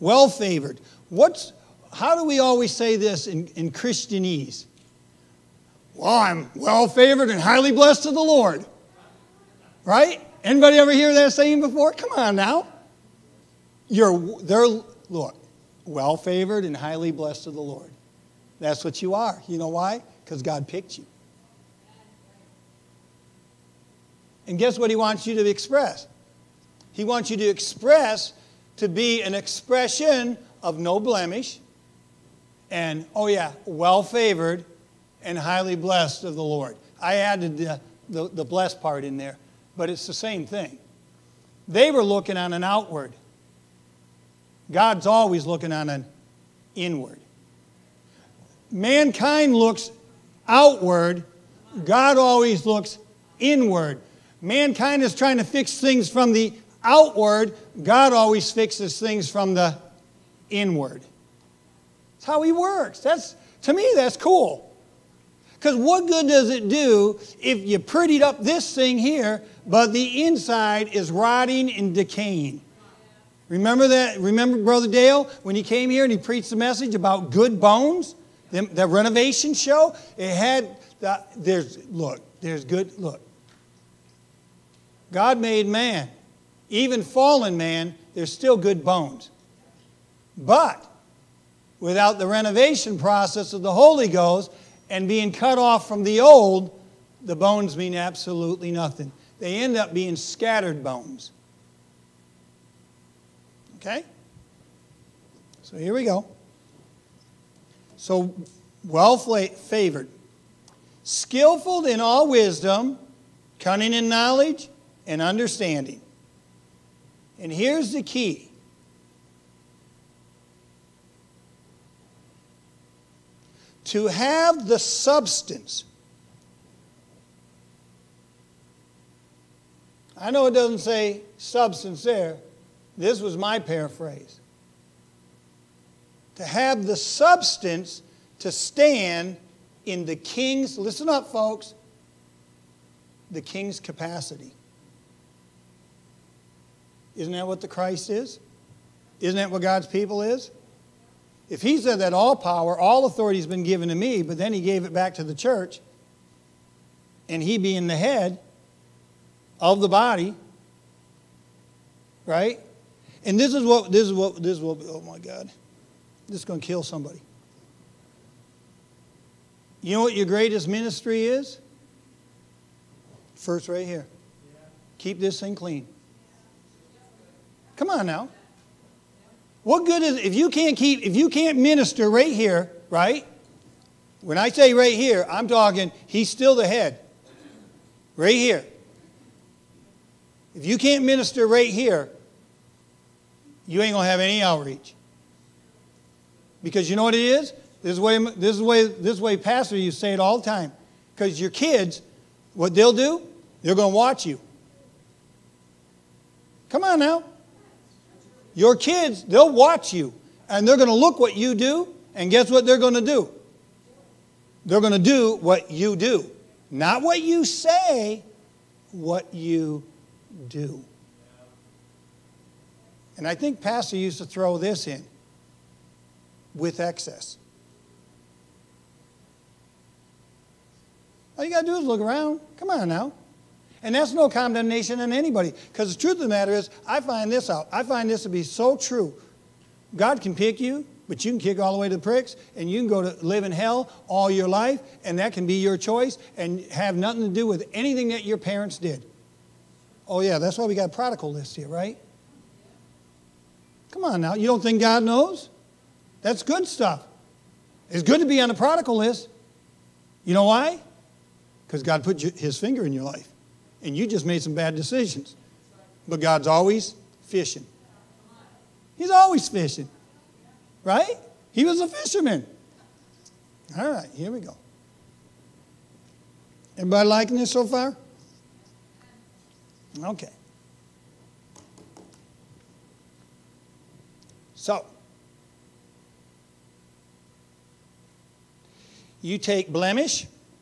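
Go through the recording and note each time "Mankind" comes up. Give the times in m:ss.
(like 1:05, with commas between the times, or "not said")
0:48, 0:54.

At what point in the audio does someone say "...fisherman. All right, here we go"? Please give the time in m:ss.
4:31.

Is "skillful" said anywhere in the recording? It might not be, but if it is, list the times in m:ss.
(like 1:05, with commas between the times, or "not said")
1:51.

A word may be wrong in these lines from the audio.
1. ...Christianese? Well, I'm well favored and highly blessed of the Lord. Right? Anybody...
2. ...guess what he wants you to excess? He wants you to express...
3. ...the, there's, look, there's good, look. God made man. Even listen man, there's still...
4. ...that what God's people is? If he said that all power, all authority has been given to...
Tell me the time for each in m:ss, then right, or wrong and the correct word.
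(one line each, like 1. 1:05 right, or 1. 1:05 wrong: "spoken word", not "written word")
1. 0:03 right
2. 0:24 wrong: "express", not "excess"
3. 1:21 wrong: "fallen", not "listen"
4. 2:29 right.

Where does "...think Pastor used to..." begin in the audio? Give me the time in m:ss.
3:43.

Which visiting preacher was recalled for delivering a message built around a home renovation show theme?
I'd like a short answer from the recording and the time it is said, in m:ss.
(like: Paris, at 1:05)
Brother Dale, at 1:14.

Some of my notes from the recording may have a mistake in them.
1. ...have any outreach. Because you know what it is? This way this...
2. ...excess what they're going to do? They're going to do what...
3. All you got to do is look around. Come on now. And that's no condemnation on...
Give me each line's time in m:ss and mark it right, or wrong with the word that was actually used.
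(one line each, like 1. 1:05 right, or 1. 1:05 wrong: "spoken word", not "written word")
1. 3:14 right
2. 3:32 wrong: "guess", not "excess"
3. 3:51 right.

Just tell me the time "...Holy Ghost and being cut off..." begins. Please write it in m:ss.
1:33.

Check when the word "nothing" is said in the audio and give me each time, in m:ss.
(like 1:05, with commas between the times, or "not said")
1:38, 4:06.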